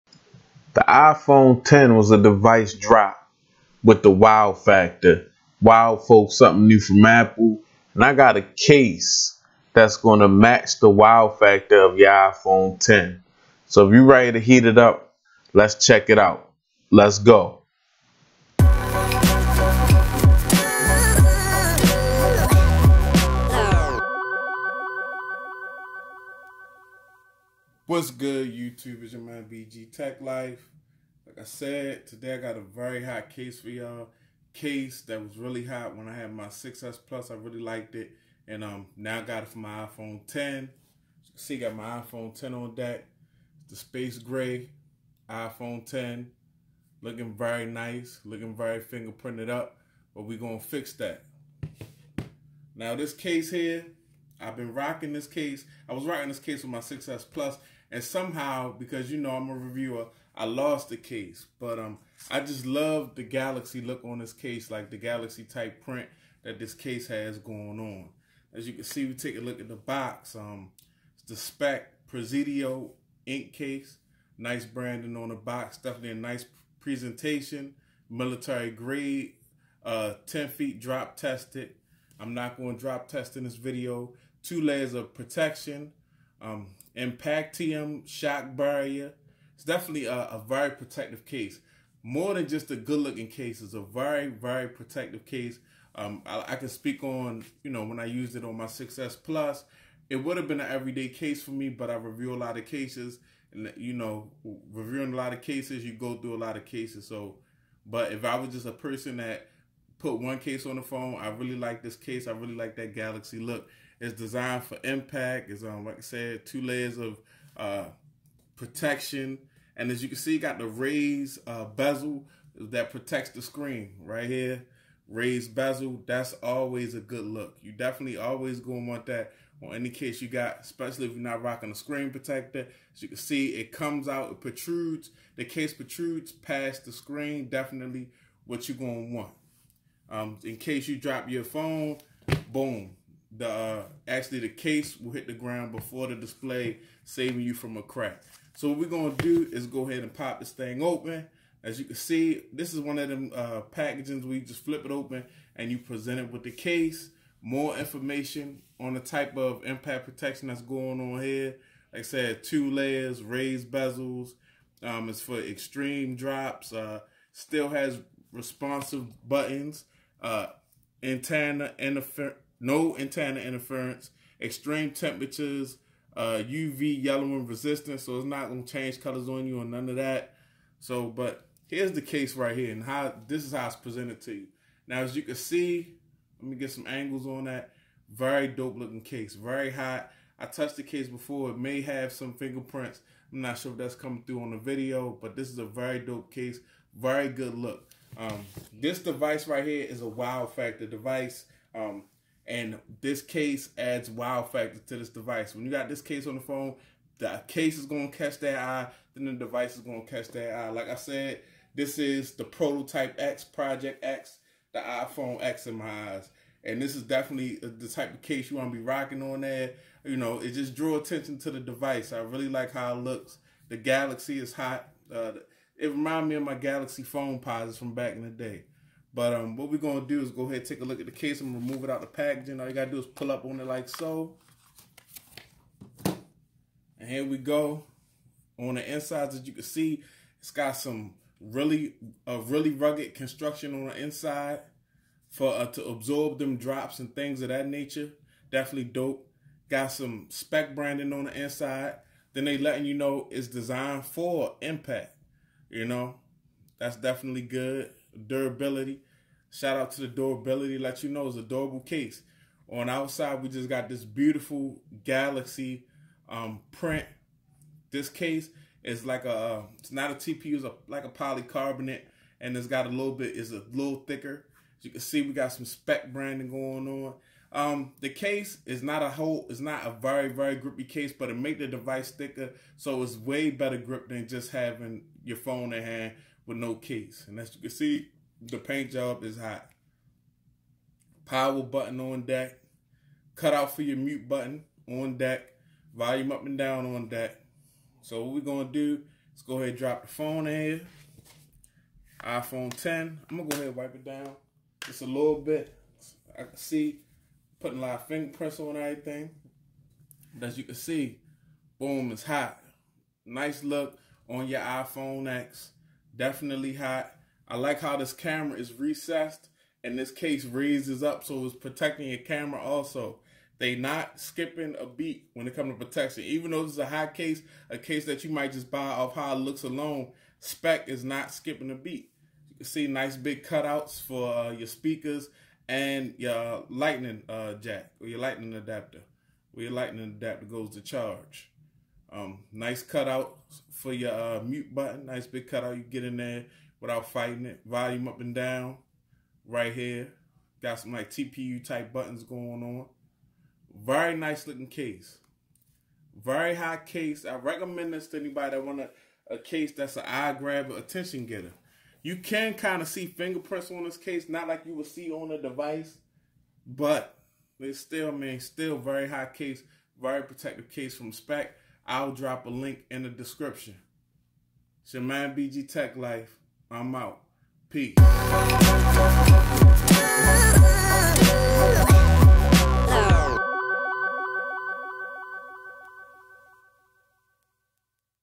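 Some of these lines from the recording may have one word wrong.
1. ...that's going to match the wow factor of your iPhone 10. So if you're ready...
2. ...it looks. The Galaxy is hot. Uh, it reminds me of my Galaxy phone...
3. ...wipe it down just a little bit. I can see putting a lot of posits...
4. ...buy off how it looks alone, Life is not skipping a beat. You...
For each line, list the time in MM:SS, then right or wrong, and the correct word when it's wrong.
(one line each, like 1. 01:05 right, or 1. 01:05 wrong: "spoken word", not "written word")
1. 00:09 right
2. 03:42 right
3. 05:03 wrong: "fingerprints", not "posits"
4. 05:28 wrong: "Speck", not "Life".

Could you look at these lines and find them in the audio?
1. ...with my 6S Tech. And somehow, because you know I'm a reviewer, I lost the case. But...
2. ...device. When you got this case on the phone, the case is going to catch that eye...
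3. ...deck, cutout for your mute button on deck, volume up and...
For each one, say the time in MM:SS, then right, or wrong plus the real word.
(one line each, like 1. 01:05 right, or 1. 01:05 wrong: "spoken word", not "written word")
1. 00:56 wrong: "Plus", not "Tech"
2. 03:25 right
3. 04:52 right.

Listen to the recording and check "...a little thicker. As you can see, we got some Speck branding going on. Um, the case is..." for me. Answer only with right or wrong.
right.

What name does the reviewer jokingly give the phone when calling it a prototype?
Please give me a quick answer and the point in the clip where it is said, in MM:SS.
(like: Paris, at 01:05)
Project X, at 03:33.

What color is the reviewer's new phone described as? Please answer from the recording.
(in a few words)
Space gray.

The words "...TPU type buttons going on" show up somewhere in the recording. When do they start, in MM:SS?
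05:51.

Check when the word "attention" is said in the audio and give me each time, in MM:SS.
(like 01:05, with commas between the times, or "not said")
03:40, 06:00.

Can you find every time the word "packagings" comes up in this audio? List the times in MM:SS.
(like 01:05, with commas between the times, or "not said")
02:33, 03:52.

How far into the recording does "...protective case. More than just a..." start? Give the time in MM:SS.
01:30.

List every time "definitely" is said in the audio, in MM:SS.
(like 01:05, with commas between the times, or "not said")
01:15, 01:29, 02:07, 02:17, 03:37, 04:08, 04:16, 05:16.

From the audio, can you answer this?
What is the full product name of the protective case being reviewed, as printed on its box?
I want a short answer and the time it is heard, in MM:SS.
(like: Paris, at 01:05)
Speck Presidio Ink, at 01:11.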